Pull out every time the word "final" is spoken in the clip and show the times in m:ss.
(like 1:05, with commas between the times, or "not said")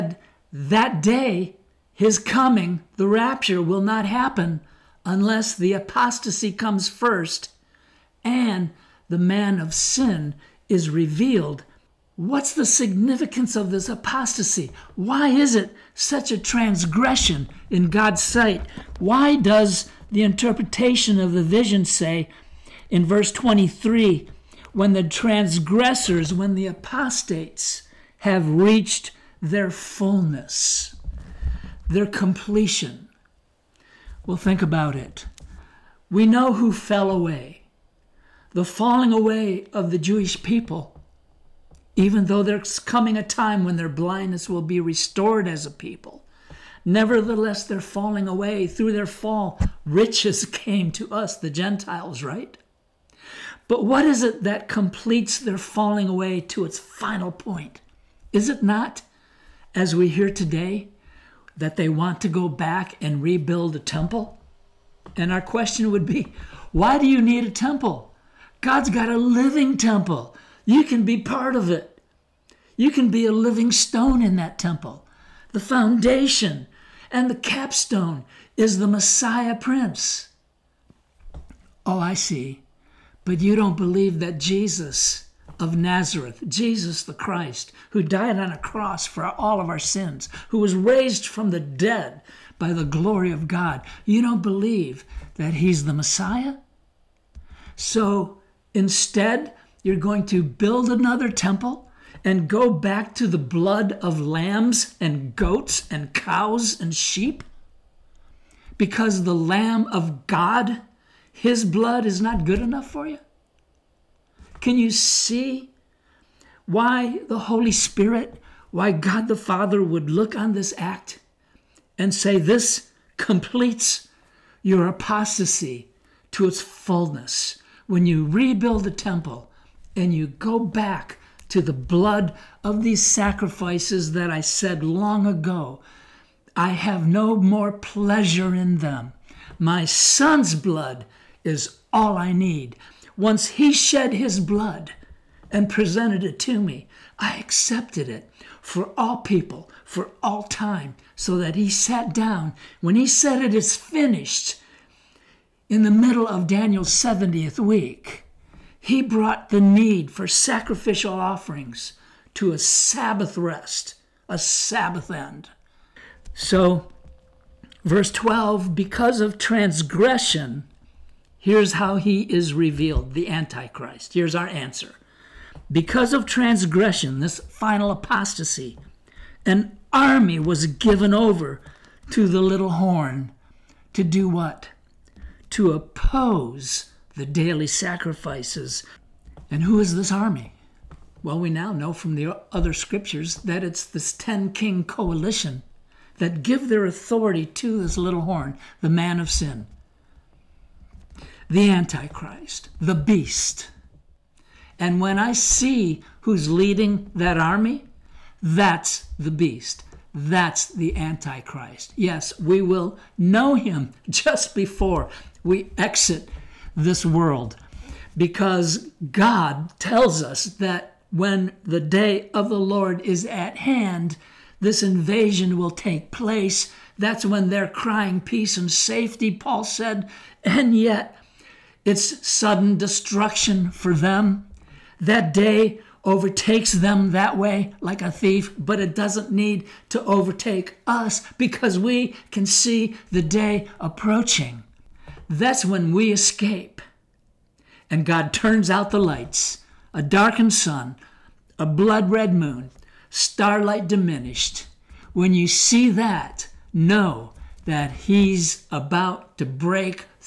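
0:56, 2:57.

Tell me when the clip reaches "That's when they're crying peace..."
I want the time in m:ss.
3:46.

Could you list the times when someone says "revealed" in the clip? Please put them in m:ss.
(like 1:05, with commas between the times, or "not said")
0:10, 2:52.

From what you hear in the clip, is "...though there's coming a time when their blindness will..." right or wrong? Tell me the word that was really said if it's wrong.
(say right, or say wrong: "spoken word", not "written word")
right.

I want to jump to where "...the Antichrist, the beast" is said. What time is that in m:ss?
3:21.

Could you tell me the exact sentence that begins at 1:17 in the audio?
And the capstone is the Messiah Prince.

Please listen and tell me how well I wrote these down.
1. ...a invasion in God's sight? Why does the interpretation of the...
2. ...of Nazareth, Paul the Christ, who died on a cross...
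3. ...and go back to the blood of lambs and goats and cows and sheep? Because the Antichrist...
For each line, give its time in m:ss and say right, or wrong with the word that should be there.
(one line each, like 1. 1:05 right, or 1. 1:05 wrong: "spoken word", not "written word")
1. 0:16 wrong: "transgression", not "invasion"
2. 1:25 wrong: "Jesus", not "Paul"
3. 1:42 wrong: "Lamb", not "Antichrist".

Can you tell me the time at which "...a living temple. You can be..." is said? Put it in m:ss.
1:09.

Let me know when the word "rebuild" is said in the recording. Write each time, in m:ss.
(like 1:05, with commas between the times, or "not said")
1:03, 2:08.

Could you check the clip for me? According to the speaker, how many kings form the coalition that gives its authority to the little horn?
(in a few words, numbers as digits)
10.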